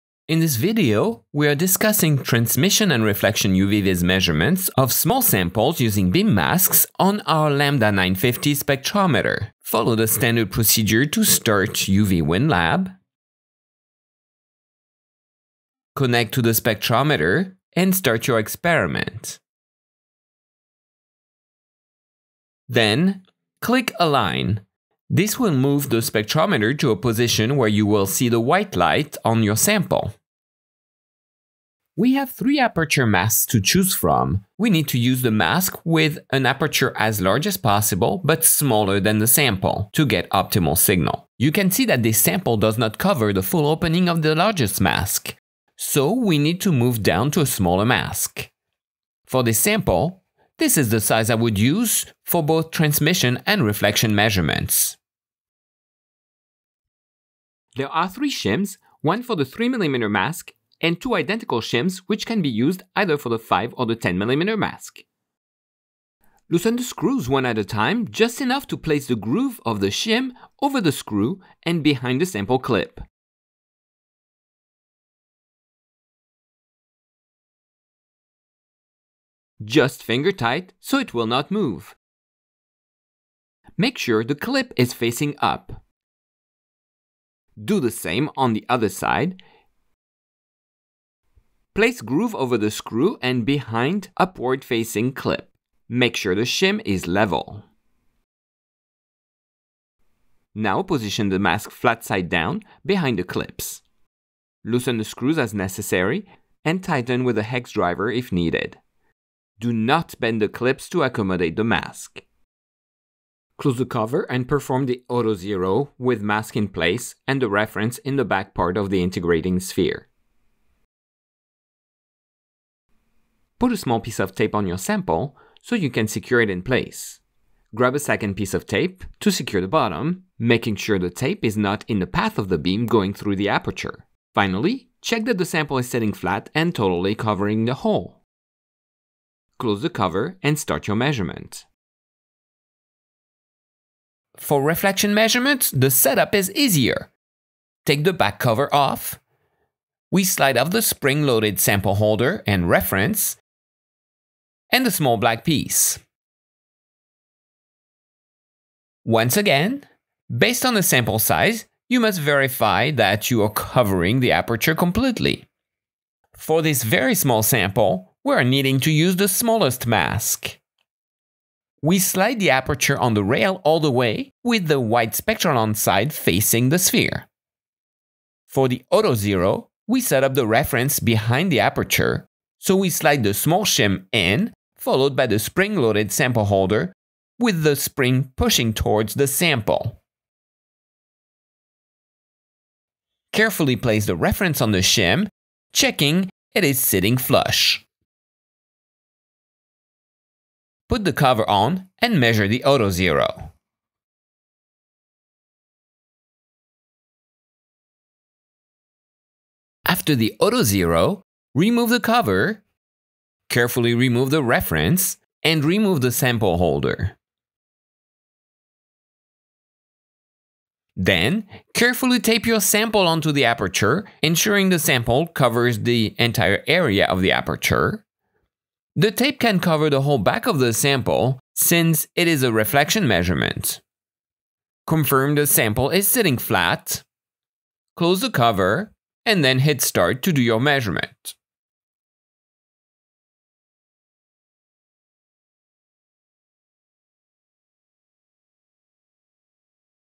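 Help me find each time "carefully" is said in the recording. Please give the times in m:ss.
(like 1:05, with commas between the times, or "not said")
3:13, 3:33, 3:41.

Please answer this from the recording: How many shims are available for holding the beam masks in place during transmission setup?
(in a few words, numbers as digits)
3.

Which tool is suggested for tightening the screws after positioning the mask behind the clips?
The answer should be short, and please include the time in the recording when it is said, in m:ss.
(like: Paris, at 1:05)
Hex driver, at 1:47.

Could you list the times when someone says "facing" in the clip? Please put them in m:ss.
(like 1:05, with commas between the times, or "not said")
1:24, 1:34, 2:56.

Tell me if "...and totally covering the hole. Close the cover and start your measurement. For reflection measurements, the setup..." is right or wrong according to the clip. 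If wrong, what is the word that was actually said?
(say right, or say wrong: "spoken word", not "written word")
right.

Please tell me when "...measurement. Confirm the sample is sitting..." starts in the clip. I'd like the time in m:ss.
3:53.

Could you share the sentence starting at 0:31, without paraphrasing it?
We have three aperture masks to choose from.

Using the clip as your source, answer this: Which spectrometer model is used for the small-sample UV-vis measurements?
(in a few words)
Lambda 950.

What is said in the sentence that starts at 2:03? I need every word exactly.
Put a small piece of tape on your sample so you can secure it in place.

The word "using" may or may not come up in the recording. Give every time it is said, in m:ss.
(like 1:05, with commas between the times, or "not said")
0:05.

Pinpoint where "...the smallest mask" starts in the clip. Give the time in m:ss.
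2:49.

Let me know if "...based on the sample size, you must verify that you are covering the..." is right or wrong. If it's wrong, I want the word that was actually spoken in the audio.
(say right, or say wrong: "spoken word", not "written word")
right.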